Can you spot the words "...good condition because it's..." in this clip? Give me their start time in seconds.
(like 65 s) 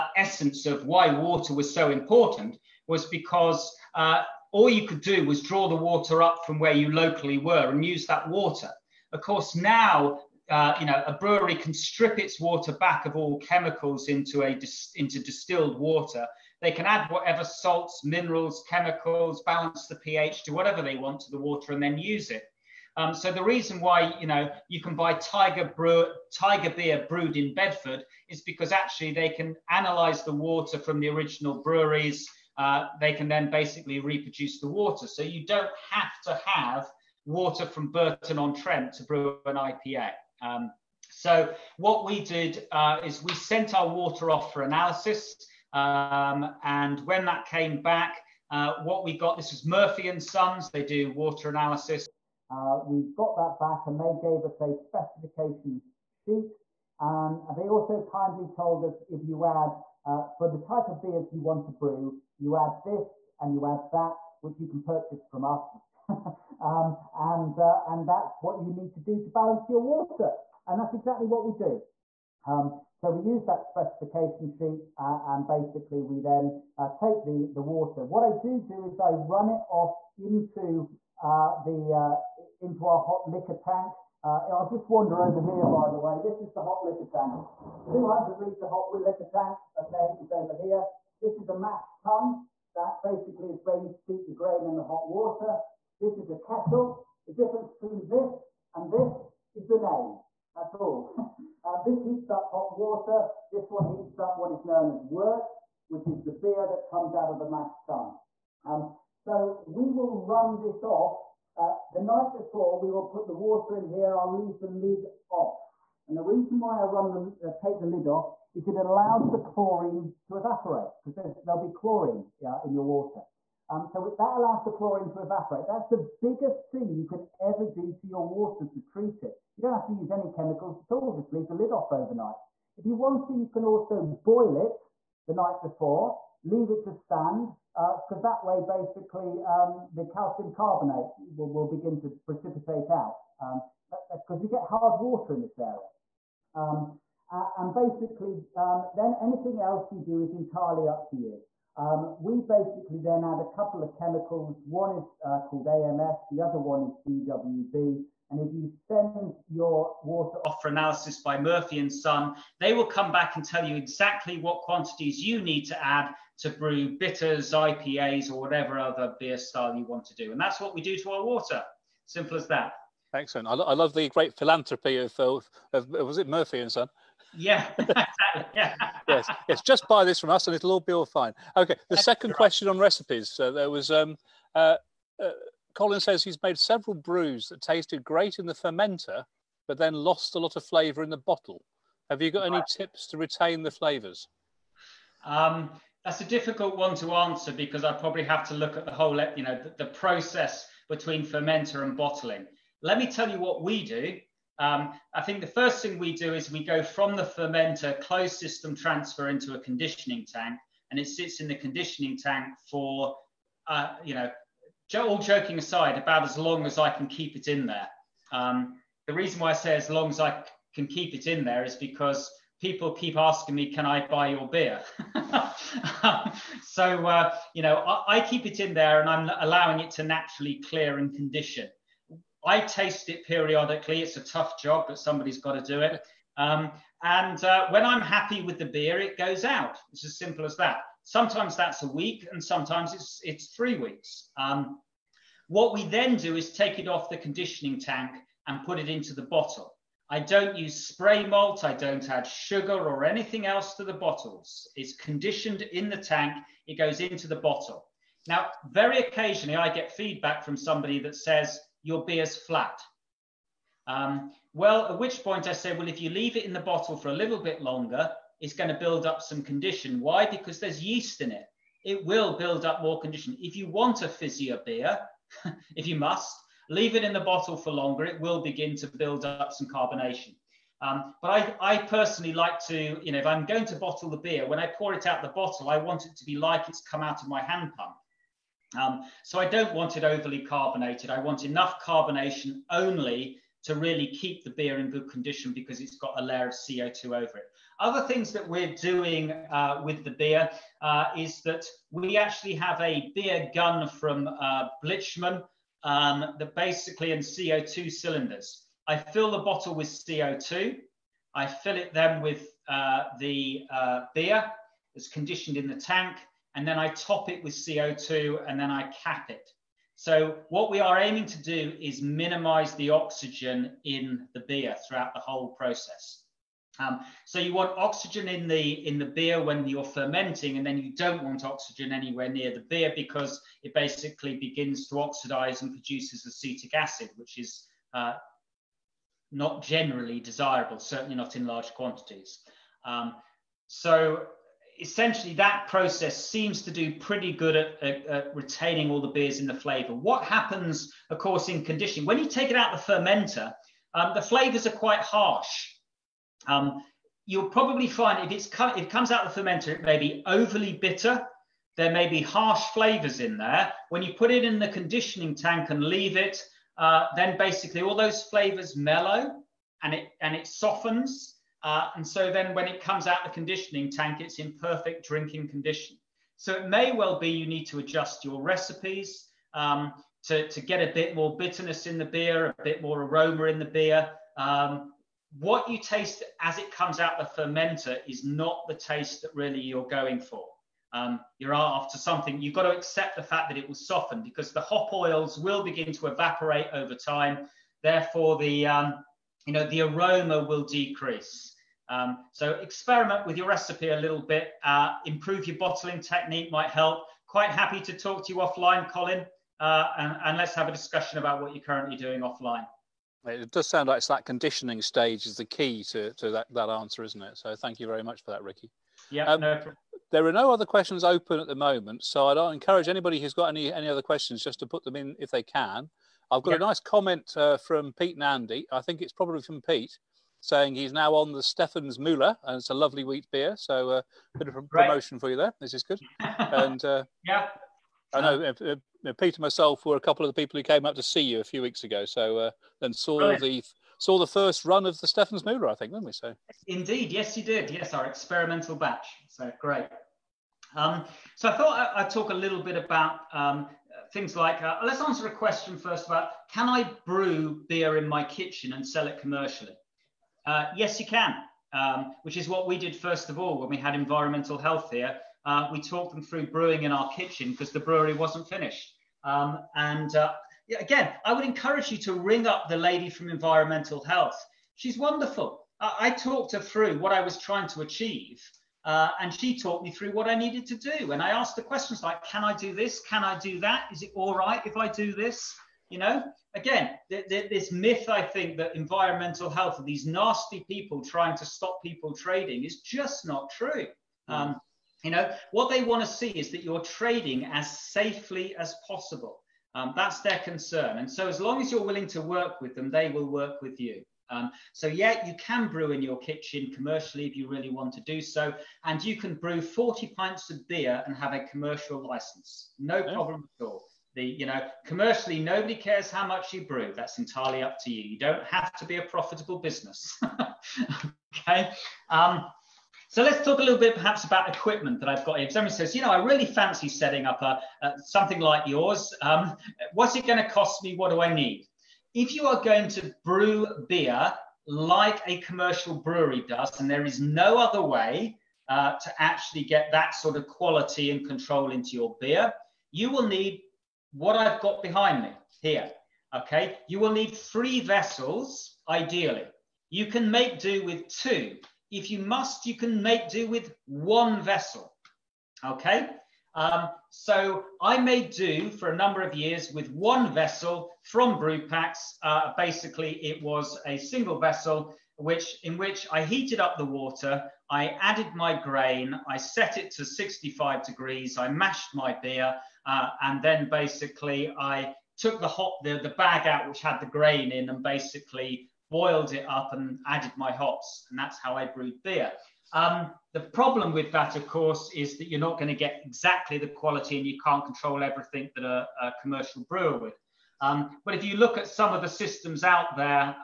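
294 s.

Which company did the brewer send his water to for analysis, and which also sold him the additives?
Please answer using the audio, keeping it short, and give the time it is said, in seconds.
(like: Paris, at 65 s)
Murphy and Sons, at 49 s.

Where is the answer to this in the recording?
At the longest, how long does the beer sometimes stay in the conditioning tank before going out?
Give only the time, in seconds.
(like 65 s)
243 s.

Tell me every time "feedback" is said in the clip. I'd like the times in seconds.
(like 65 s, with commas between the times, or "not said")
259 s.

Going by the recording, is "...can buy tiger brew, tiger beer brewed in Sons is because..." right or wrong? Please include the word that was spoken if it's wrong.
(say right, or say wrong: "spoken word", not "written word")
wrong: "Bedford", not "Sons".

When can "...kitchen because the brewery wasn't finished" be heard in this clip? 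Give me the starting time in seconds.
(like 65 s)
467 s.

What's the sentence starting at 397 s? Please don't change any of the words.
Therefore, the, um, you know, the aroma will decrease.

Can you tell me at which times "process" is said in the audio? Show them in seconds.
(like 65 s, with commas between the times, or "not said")
199 s, 325 s, 345 s.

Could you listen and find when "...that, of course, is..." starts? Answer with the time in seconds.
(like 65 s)
584 s.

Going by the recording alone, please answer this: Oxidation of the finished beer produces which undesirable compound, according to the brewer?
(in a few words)
Acetic acid.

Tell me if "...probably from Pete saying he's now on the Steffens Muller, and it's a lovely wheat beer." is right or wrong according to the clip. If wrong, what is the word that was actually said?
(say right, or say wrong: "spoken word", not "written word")
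right.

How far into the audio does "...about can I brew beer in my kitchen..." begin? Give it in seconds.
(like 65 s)
456 s.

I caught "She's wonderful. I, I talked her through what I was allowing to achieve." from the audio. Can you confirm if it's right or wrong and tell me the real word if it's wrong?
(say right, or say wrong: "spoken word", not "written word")
wrong: "trying", not "allowing".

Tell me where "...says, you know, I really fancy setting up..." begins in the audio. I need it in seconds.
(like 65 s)
525 s.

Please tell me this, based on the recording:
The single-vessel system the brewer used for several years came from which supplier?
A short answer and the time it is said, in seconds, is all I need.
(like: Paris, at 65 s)
Brewpax, at 561 s.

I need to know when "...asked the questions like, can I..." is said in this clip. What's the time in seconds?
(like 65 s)
481 s.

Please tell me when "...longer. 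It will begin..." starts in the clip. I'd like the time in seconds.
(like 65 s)
277 s.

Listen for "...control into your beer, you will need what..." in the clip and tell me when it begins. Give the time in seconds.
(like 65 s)
541 s.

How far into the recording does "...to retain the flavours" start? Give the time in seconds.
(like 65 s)
193 s.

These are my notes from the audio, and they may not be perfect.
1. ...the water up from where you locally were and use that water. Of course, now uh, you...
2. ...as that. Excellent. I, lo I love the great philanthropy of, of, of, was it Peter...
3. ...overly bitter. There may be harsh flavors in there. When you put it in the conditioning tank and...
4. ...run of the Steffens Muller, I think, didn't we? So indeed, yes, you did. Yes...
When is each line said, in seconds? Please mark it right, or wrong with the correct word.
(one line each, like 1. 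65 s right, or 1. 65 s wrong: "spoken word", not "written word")
1. 5 s right
2. 172 s wrong: "Murphy", not "Peter"
3. 360 s right
4. 444 s right.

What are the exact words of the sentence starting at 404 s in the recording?
Uh, improve your bottling technique might help.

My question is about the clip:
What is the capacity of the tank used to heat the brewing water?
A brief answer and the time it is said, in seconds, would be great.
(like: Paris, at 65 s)
200 litres, at 87 s.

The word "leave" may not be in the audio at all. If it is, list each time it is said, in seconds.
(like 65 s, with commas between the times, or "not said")
114 s, 131 s, 136 s, 266 s, 276 s, 365 s.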